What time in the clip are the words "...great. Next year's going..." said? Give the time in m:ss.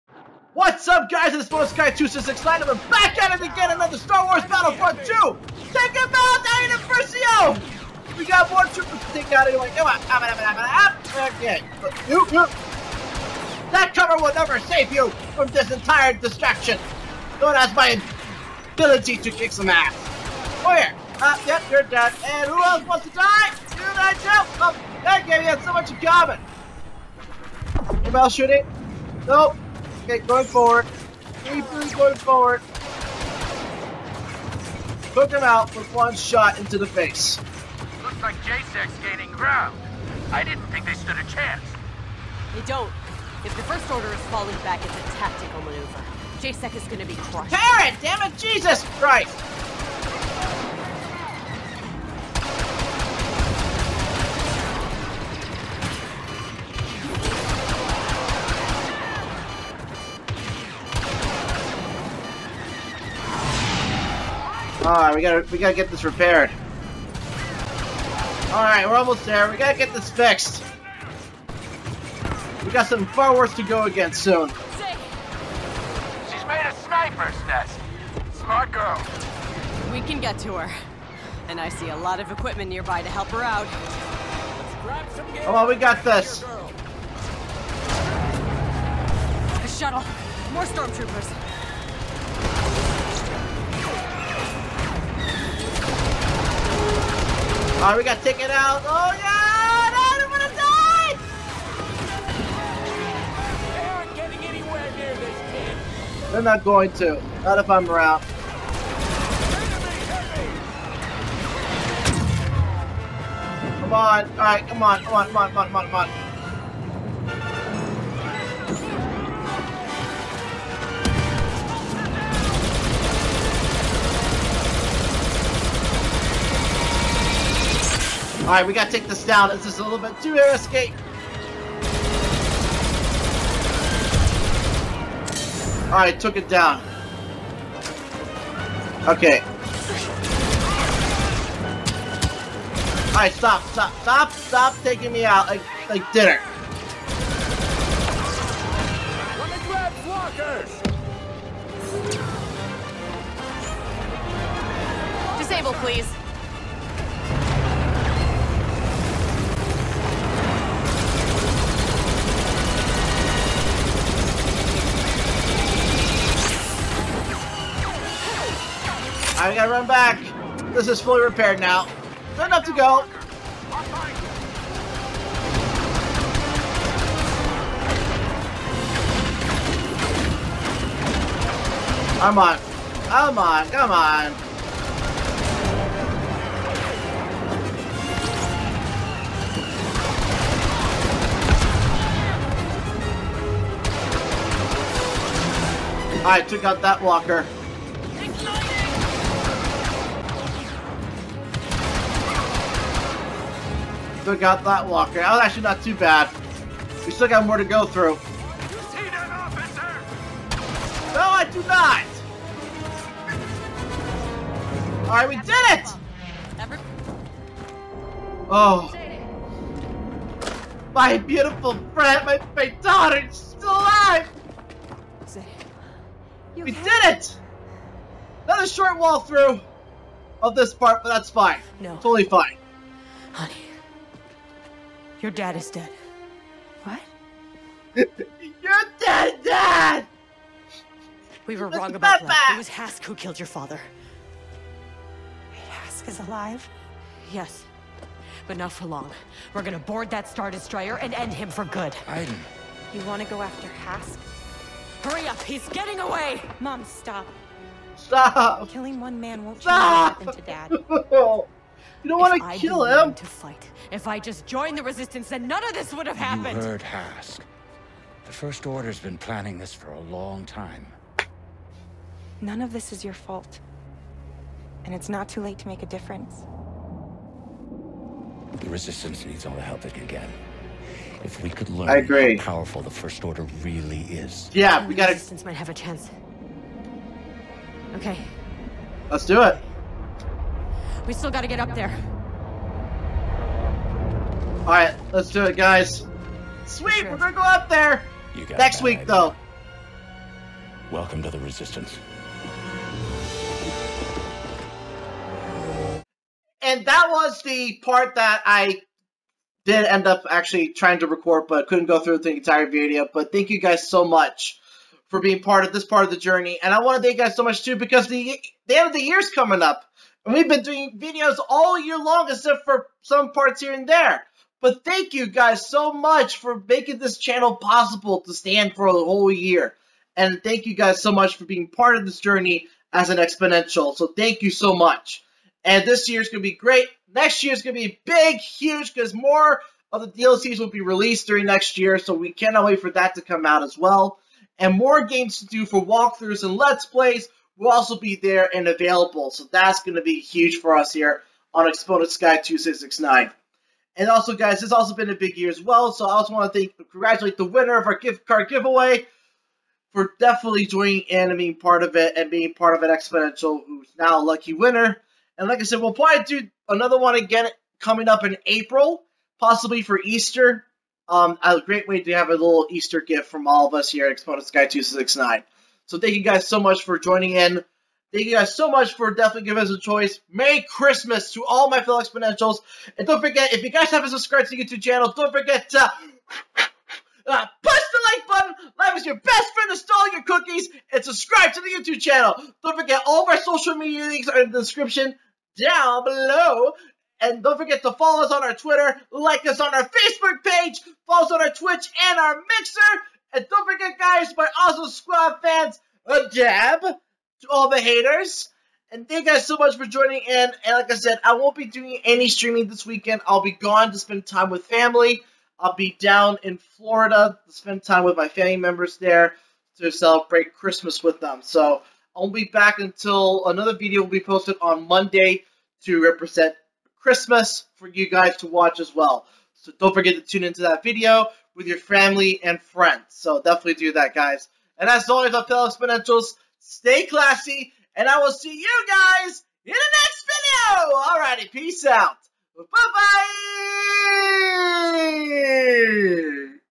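5:36.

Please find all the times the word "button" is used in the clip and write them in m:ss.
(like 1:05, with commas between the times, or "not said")
6:28.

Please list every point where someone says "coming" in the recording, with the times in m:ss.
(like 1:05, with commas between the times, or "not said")
5:19, 6:07.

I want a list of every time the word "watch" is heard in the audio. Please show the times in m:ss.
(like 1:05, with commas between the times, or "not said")
7:08.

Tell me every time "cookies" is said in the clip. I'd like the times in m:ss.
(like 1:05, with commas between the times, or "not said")
6:30.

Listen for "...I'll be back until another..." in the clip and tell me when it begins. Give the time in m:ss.
7:02.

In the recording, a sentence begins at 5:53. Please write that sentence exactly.
And also, guys, it's also been a big year as well.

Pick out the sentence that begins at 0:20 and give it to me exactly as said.
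Oh yeah, uh, yep, you're dead, and who else wants to die?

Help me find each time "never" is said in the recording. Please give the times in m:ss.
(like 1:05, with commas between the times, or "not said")
0:14.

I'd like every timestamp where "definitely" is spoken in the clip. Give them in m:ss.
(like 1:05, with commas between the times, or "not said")
6:00, 6:19, 7:13.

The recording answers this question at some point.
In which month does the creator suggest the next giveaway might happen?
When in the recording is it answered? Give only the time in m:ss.
6:08.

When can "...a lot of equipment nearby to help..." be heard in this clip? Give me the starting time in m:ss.
1:21.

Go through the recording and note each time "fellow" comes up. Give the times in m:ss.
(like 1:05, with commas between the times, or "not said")
6:21, 7:15.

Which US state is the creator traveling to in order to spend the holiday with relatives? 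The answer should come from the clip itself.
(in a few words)
Florida.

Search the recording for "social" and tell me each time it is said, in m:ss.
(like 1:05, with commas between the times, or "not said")
6:33.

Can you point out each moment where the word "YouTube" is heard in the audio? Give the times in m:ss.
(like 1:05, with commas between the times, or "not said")
6:24, 6:31.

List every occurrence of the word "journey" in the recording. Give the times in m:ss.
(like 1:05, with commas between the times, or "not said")
5:16, 5:32.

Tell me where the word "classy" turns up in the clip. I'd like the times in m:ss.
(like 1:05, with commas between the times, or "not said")
7:17.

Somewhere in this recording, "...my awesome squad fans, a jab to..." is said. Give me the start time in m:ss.
6:44.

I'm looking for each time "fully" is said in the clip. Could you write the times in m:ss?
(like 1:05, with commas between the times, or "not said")
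2:51.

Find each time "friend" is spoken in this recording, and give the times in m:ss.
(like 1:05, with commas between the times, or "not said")
3:41, 6:29, 7:12.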